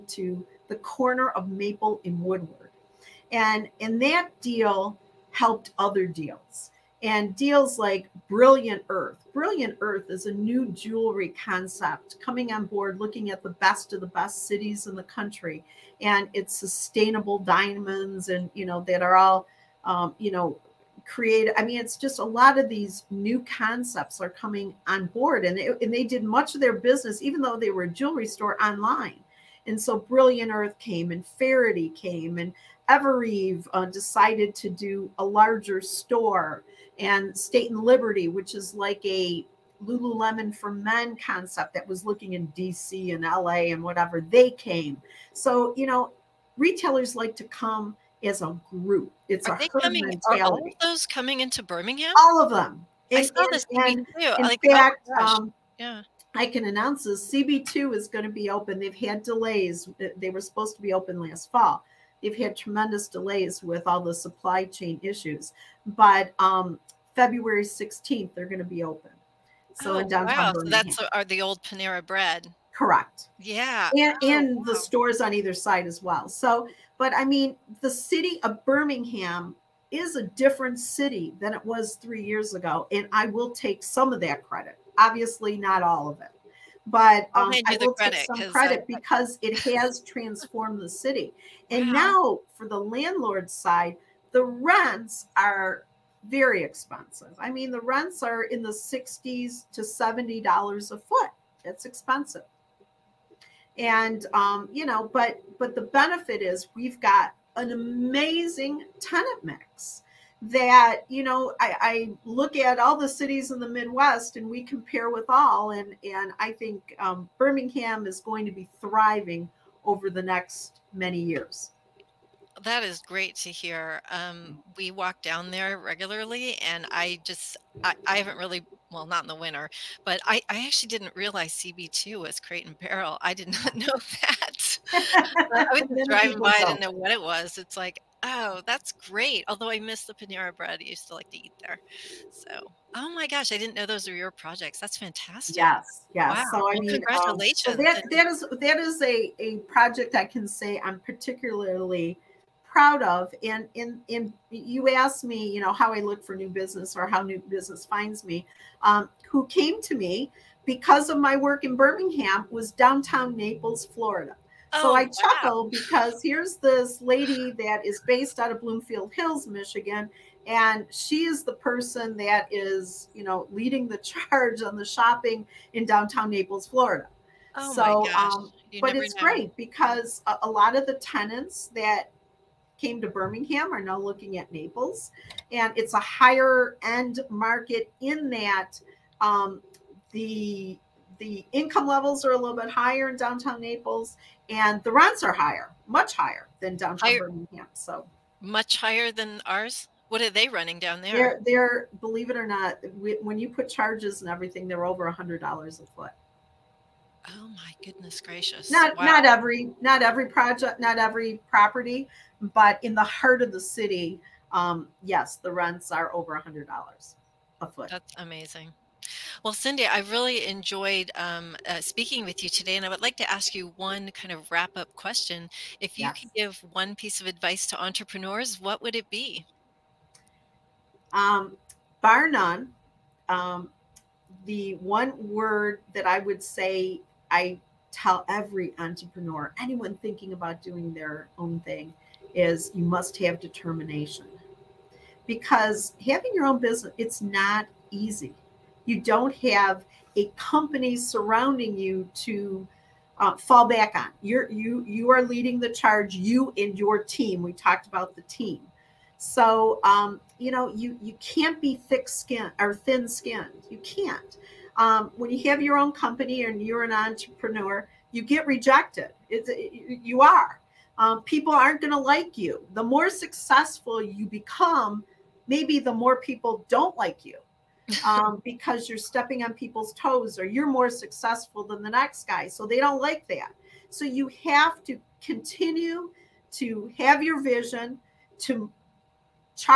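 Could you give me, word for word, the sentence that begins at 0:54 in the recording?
In like, oh fact, oh um, yeah.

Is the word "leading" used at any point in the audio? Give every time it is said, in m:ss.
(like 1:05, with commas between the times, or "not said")
2:53, 4:15.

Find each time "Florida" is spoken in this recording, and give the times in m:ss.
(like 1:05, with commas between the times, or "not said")
2:43, 2:56.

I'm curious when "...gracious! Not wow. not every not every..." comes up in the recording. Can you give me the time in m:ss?
3:28.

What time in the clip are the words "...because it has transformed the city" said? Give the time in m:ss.
1:28.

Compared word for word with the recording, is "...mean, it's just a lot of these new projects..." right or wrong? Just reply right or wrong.
wrong.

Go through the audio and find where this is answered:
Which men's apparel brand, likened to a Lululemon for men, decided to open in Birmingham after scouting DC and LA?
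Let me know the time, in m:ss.
0:37.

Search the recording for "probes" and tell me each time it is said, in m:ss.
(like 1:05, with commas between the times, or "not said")
not said.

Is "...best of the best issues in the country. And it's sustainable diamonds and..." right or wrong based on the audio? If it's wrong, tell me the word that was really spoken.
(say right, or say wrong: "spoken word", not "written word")
wrong: "cities", not "issues".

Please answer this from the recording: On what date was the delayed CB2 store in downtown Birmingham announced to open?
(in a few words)
February 16.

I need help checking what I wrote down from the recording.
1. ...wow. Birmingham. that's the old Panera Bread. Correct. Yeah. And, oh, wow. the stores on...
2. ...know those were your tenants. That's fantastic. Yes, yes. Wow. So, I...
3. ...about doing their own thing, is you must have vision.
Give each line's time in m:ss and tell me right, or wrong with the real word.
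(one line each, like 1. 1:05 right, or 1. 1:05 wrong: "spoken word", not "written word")
1. 1:10 right
2. 2:23 wrong: "projects", not "tenants"
3. 4:00 wrong: "determination", not "vision".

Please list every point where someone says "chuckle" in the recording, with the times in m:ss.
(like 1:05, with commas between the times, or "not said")
2:45.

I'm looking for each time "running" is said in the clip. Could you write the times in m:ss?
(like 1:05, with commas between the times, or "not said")
3:20.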